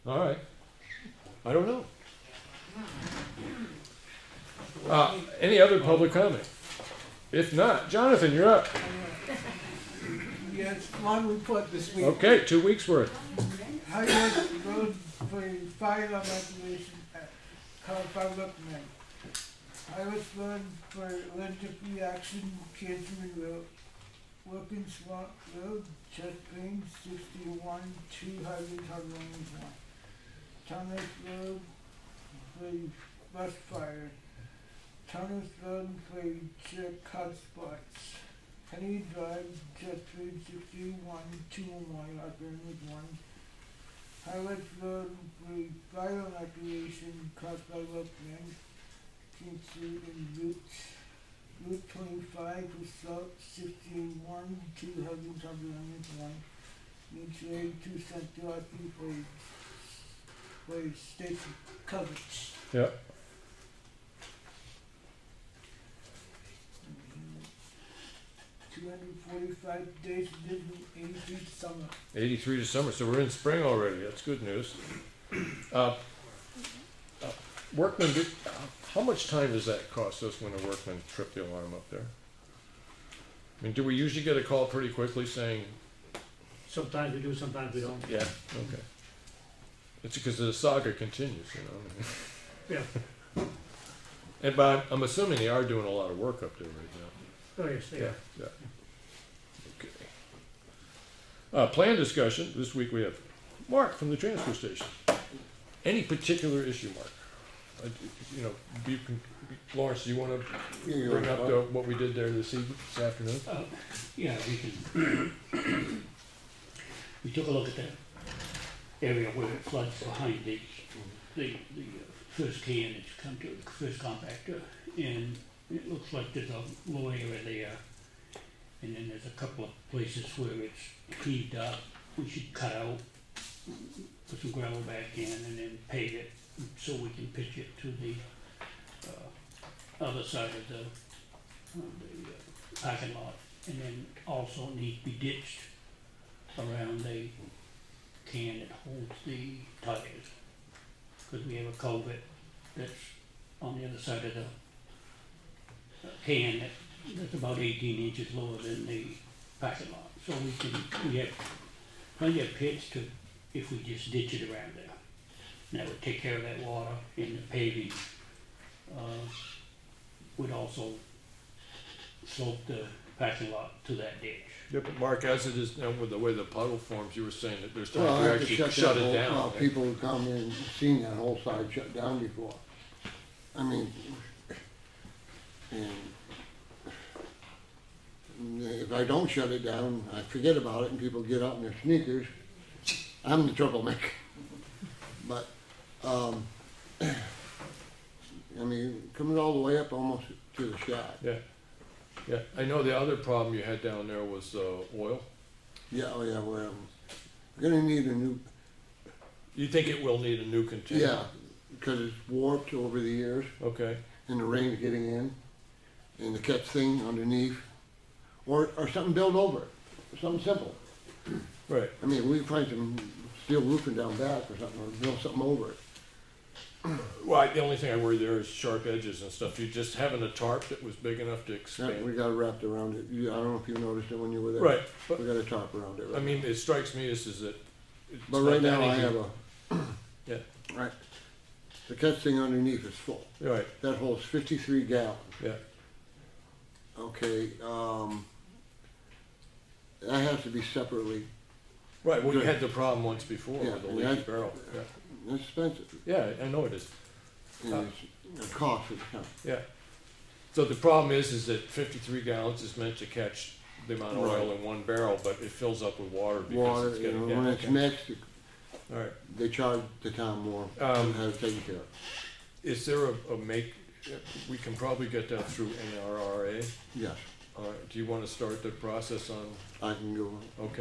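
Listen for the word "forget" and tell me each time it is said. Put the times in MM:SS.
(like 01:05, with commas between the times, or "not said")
03:10.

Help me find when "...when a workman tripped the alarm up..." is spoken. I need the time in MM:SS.
01:20.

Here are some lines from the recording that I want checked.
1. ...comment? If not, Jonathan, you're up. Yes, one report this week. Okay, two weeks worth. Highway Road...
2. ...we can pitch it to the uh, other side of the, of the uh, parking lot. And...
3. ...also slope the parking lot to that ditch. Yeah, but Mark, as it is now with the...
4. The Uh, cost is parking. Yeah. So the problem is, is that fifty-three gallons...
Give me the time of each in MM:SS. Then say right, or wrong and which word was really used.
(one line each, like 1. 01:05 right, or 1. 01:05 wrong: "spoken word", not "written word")
1. 00:06 right
2. 02:16 right
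3. 02:50 right
4. 04:17 wrong: "coming", not "parking".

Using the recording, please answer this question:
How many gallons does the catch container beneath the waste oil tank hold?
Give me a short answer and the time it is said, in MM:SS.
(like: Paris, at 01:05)
53, at 04:04.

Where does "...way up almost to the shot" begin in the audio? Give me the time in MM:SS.
03:19.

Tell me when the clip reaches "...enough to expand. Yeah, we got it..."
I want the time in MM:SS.
03:51.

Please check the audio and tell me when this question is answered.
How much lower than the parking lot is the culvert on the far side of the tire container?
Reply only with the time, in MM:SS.
02:37.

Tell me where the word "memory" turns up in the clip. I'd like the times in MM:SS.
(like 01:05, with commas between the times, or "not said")
not said.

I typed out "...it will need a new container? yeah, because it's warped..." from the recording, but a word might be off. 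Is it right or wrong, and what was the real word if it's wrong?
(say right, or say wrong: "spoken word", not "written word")
right.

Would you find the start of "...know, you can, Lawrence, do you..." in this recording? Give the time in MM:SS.
01:48.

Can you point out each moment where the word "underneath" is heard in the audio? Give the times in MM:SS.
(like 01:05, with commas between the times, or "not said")
03:37, 04:02.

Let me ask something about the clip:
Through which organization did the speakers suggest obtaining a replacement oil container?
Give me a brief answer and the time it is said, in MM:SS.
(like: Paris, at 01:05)
NRRA, at 04:35.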